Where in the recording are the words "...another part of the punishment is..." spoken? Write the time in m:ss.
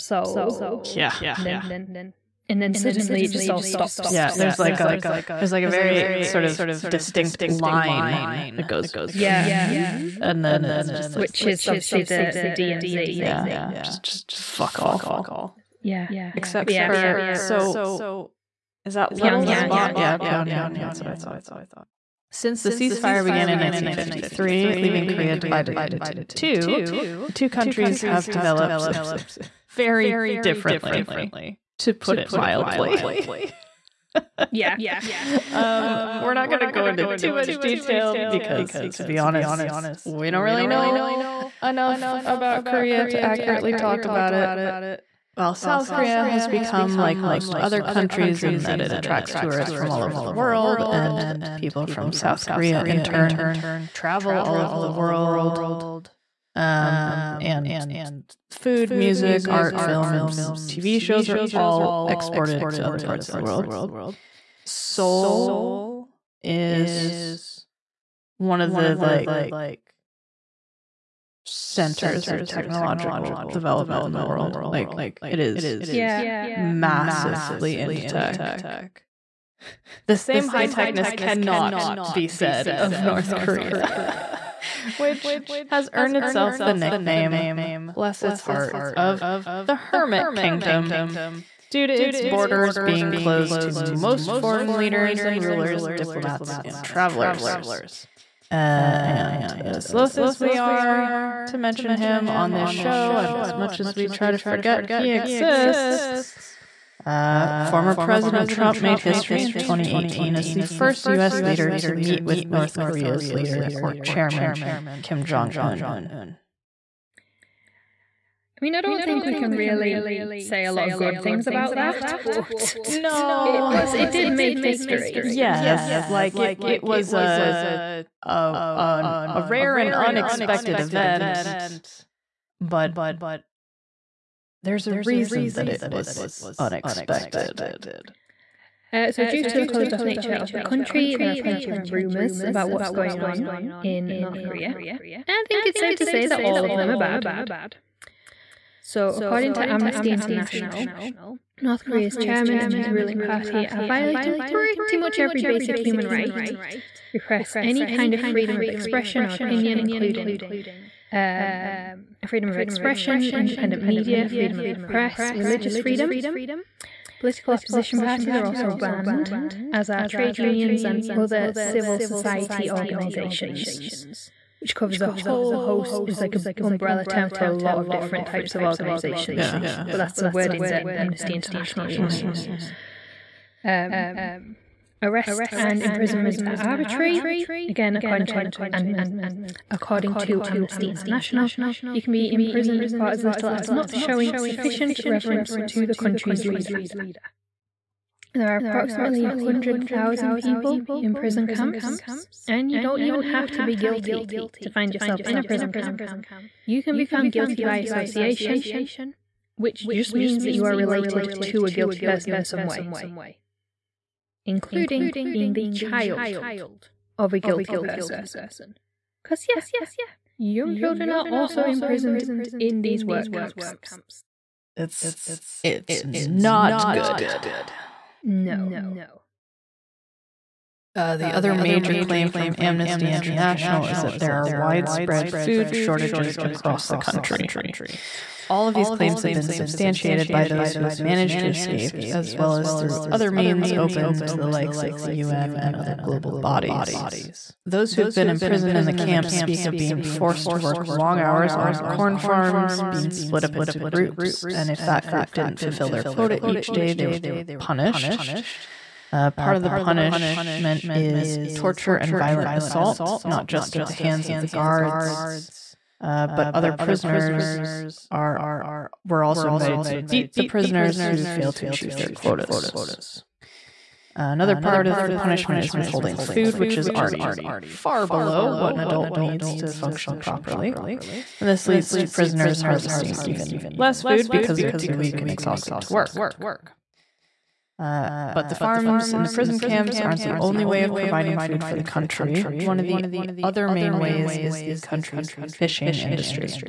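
4:34.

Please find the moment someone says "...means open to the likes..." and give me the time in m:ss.
4:03.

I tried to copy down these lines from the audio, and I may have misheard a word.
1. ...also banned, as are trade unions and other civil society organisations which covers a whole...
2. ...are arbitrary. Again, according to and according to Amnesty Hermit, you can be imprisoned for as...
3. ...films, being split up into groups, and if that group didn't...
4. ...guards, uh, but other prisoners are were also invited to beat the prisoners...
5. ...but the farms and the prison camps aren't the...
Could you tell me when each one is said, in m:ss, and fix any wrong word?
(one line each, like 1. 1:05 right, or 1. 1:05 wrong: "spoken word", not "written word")
1. 2:48 right
2. 3:06 wrong: "International", not "Hermit"
3. 4:12 wrong: "farms", not "films"
4. 4:24 right
5. 4:48 right.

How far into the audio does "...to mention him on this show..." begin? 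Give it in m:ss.
1:41.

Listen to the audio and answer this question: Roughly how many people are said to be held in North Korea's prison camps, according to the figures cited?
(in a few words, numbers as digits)
100,000.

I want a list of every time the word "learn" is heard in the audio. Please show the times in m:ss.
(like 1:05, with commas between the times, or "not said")
not said.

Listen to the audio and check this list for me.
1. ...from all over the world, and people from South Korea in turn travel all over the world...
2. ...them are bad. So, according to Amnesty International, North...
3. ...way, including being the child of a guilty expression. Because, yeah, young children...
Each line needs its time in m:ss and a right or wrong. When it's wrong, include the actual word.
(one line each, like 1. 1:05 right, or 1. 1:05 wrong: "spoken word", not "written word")
1. 0:49 right
2. 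2:26 right
3. 3:32 wrong: "person", not "expression".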